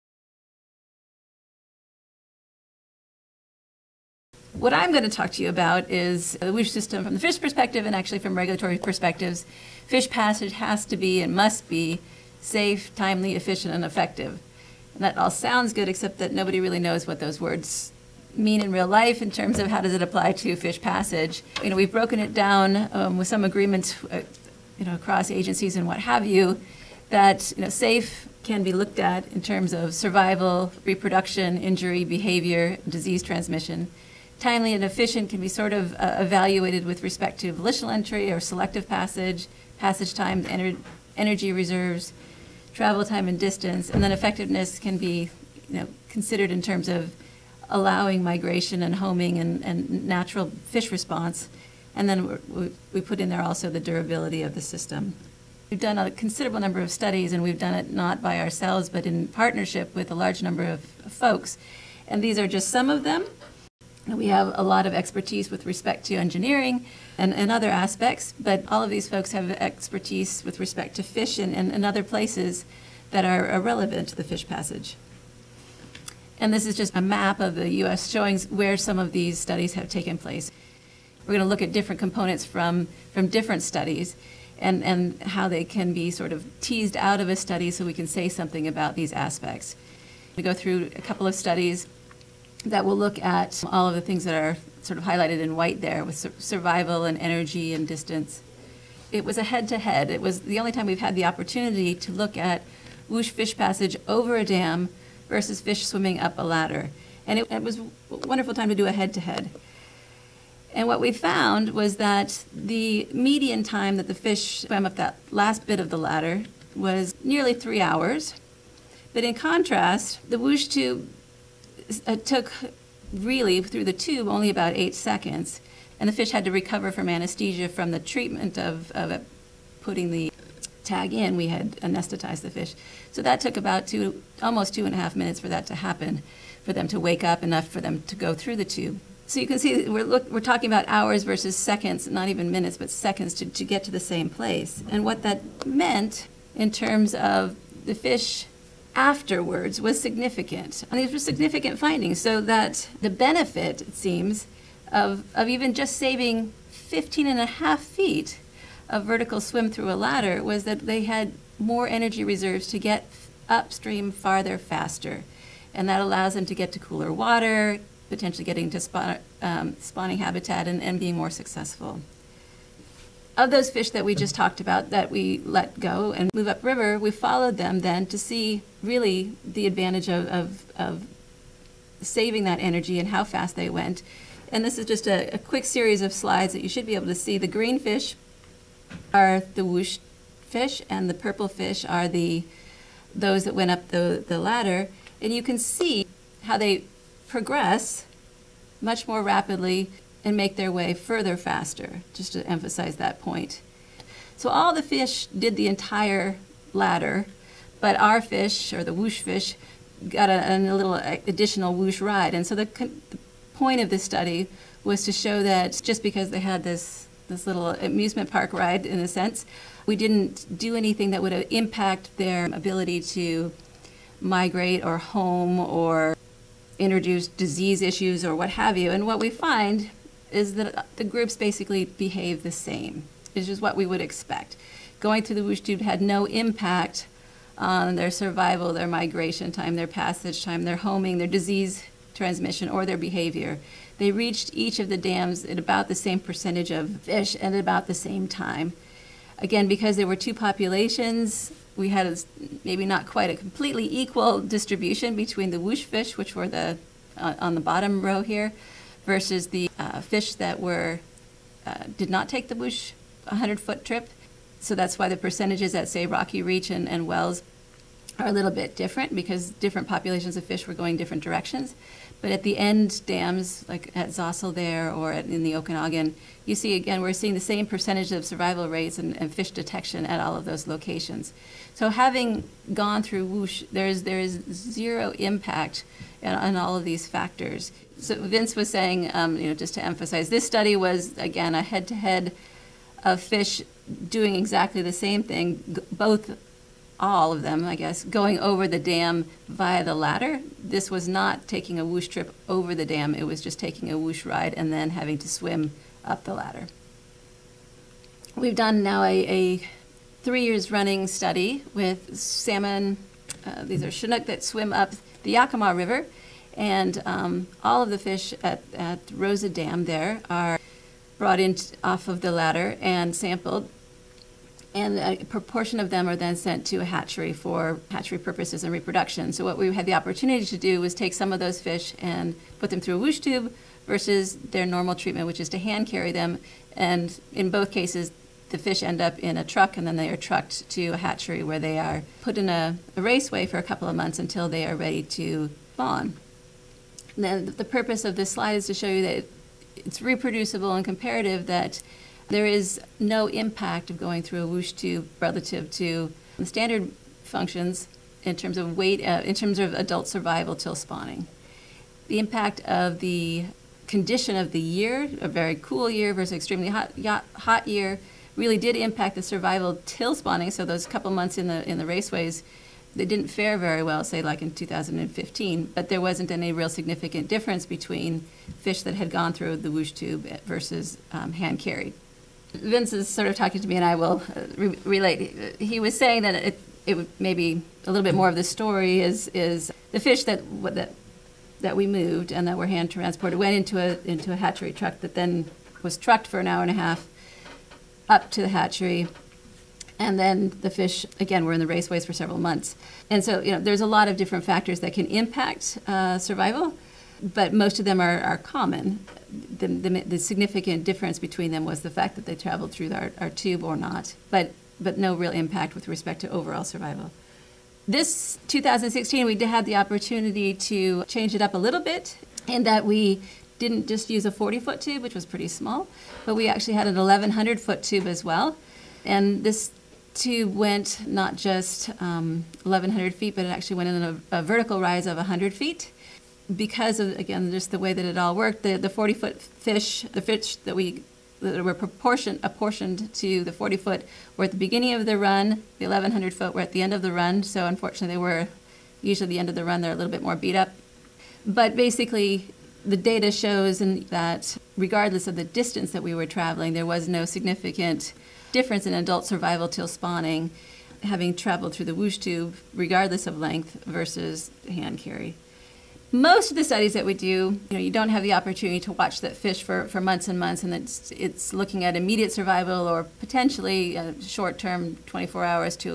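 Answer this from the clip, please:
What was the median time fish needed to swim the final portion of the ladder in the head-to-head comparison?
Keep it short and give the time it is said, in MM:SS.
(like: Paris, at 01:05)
nearly 3 hours, at 01:57.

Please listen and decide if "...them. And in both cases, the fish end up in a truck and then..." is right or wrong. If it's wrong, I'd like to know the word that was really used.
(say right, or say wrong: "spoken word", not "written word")
right.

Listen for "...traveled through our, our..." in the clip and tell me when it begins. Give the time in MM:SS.
06:52.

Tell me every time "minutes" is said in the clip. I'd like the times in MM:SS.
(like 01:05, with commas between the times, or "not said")
02:15, 02:22.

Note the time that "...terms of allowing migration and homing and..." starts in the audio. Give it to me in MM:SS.
00:46.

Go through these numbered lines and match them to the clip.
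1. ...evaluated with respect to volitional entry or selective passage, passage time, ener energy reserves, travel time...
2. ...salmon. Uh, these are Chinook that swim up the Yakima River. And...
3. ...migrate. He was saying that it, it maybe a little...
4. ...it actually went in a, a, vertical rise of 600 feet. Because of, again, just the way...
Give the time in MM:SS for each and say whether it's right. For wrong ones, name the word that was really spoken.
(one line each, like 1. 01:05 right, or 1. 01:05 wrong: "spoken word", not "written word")
1. 00:36 right
2. 05:12 right
3. 06:24 wrong: "relate", not "migrate"
4. 07:13 wrong: "100", not "600".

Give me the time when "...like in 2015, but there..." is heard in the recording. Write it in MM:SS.
06:14.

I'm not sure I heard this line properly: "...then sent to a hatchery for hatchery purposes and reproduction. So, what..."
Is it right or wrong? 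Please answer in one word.
right.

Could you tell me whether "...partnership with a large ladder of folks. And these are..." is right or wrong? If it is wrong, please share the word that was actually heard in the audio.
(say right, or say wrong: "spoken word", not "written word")
wrong: "number", not "ladder".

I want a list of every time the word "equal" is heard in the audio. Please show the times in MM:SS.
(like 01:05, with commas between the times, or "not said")
04:13.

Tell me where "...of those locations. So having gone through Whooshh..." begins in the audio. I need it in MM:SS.
04:40.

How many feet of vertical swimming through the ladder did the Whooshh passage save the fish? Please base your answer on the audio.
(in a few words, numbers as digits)
15.5 feet.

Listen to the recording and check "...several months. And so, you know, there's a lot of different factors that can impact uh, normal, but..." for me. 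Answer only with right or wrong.
wrong.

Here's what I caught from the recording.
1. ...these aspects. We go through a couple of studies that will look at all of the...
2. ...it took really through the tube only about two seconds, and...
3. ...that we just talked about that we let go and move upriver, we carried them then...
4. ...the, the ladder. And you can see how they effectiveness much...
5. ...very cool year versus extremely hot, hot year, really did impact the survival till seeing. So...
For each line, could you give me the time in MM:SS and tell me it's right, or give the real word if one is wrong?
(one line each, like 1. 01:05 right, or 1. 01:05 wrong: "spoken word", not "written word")
1. 01:28 right
2. 02:02 wrong: "eight", not "two"
3. 02:53 wrong: "followed", not "carried"
4. 03:13 wrong: "progress", not "effectiveness"
5. 06:05 wrong: "spawning", not "seeing".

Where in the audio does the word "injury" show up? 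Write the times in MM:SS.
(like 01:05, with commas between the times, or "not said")
00:31.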